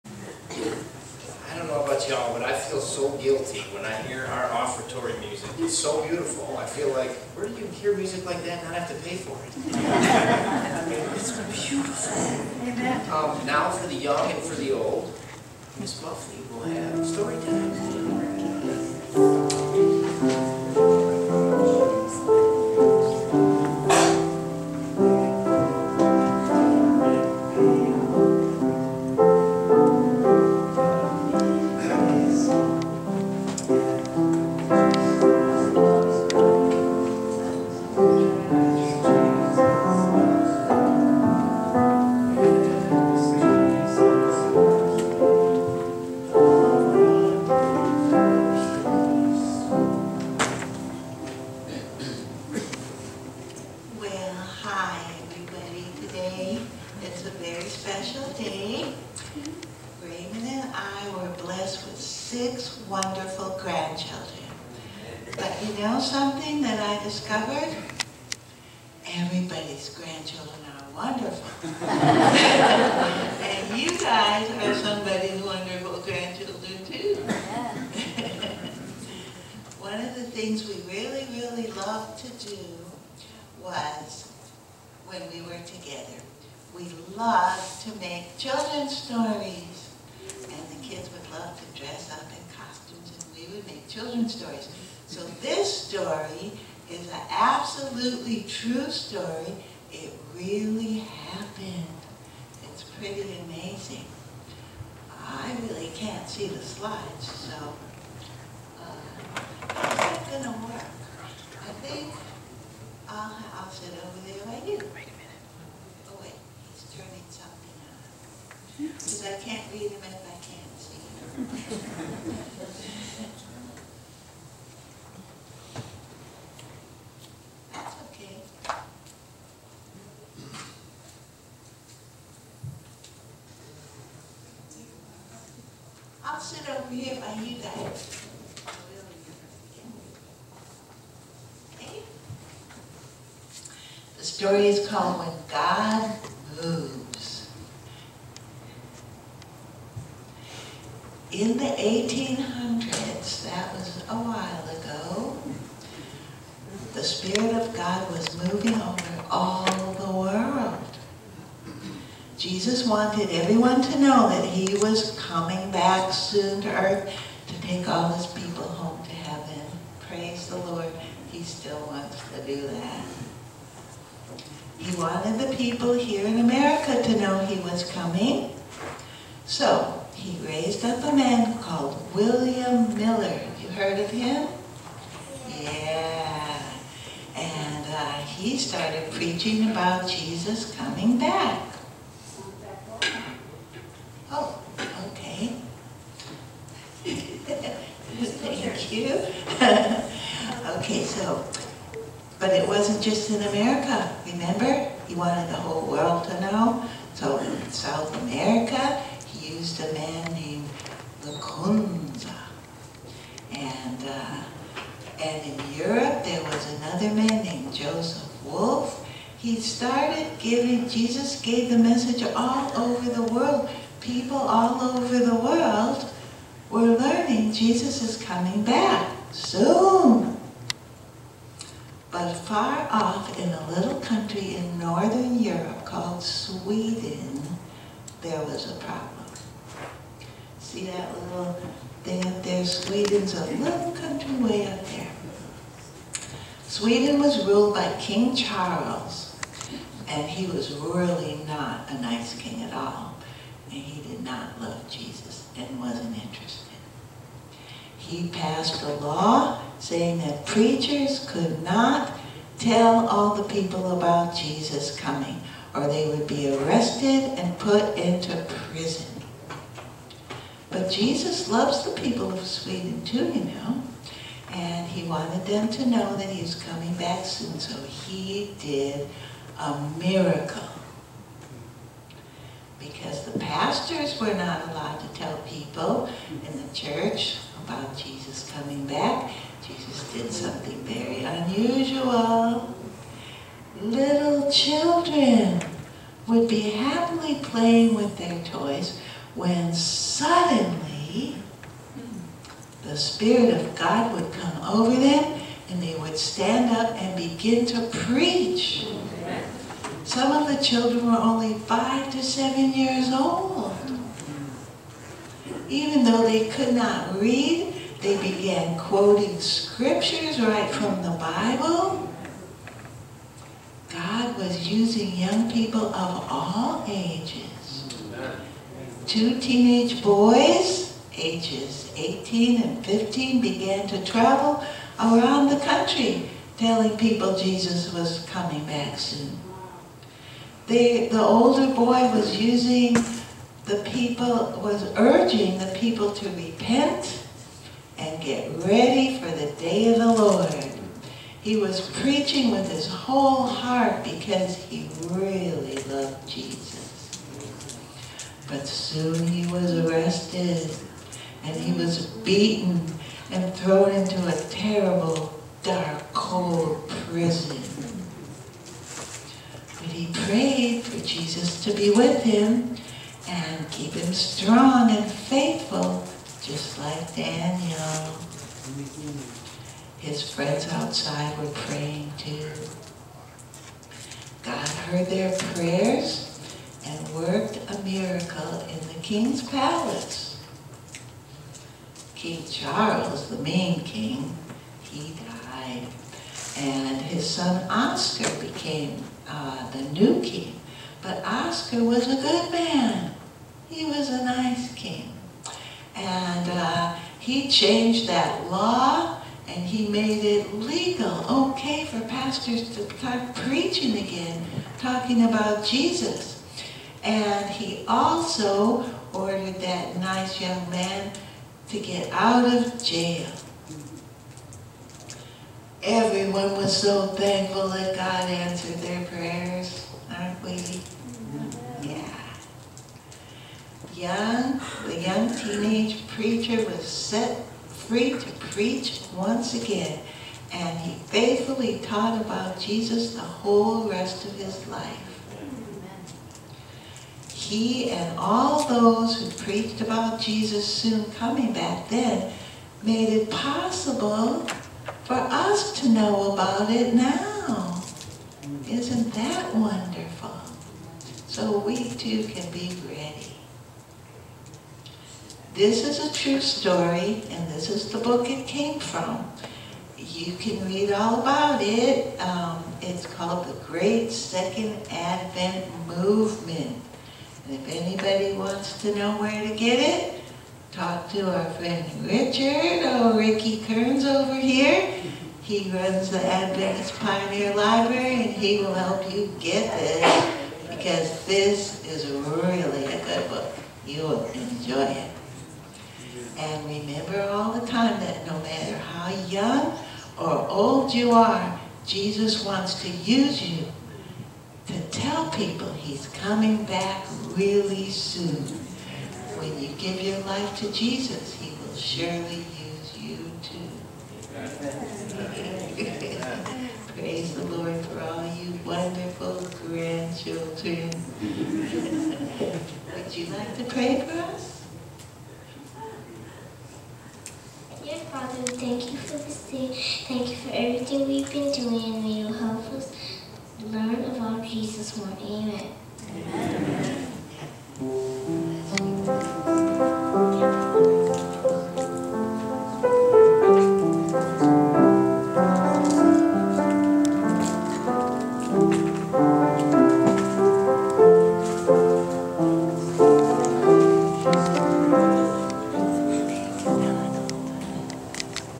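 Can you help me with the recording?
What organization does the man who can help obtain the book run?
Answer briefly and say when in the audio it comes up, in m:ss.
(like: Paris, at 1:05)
Adventist Pioneer Library, at 8:06.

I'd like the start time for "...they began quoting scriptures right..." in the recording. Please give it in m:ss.
5:18.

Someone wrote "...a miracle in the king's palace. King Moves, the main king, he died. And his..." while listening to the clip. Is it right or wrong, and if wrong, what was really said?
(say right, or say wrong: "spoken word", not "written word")
wrong: "Charles", not "Moves".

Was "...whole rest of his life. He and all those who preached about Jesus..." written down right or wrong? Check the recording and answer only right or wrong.
right.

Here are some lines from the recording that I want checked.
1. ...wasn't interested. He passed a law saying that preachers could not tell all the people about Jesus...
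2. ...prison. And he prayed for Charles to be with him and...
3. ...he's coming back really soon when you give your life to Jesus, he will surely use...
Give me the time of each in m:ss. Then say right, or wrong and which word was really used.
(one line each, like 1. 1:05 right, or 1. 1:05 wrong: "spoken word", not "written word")
1. 4:15 right
2. 6:07 wrong: "Jesus", not "Charles"
3. 8:25 right.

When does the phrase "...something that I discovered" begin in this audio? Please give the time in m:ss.
1:05.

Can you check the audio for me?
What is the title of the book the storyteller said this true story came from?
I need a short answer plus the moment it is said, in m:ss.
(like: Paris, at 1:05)
The Great Second Advent Movement, at 7:53.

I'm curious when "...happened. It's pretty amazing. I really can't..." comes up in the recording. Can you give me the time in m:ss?
1:40.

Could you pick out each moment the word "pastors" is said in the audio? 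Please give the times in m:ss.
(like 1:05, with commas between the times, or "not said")
4:43, 6:52.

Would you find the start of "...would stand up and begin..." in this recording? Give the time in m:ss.
5:05.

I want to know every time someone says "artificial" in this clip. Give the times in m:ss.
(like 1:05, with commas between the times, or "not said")
not said.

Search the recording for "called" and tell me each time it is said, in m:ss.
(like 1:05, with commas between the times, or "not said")
2:24, 3:01, 3:55, 7:53.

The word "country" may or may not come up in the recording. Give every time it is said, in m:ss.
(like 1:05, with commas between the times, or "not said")
3:53, 4:03, 5:35.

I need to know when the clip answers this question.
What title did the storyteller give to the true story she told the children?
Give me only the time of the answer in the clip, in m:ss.
2:25.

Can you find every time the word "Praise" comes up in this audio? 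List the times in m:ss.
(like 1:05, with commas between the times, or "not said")
2:50, 8:36.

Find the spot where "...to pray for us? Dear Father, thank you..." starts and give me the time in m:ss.
8:43.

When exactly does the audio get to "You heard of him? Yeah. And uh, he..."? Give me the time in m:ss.
3:03.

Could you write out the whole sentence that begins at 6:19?
His friends outside were praying too.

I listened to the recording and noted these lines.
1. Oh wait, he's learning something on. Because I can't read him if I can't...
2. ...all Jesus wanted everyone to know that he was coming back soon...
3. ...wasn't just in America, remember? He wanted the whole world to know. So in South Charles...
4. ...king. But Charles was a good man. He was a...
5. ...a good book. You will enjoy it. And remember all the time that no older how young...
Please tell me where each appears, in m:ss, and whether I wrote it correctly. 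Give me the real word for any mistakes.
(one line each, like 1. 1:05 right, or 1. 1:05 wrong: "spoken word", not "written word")
1. 1:56 wrong: "turning", not "learning"
2. 2:39 right
3. 3:22 wrong: "America", not "Charles"
4. 6:40 wrong: "Oscar", not "Charles"
5. 8:12 wrong: "matter", not "older".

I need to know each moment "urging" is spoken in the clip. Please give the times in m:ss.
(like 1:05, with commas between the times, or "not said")
5:44.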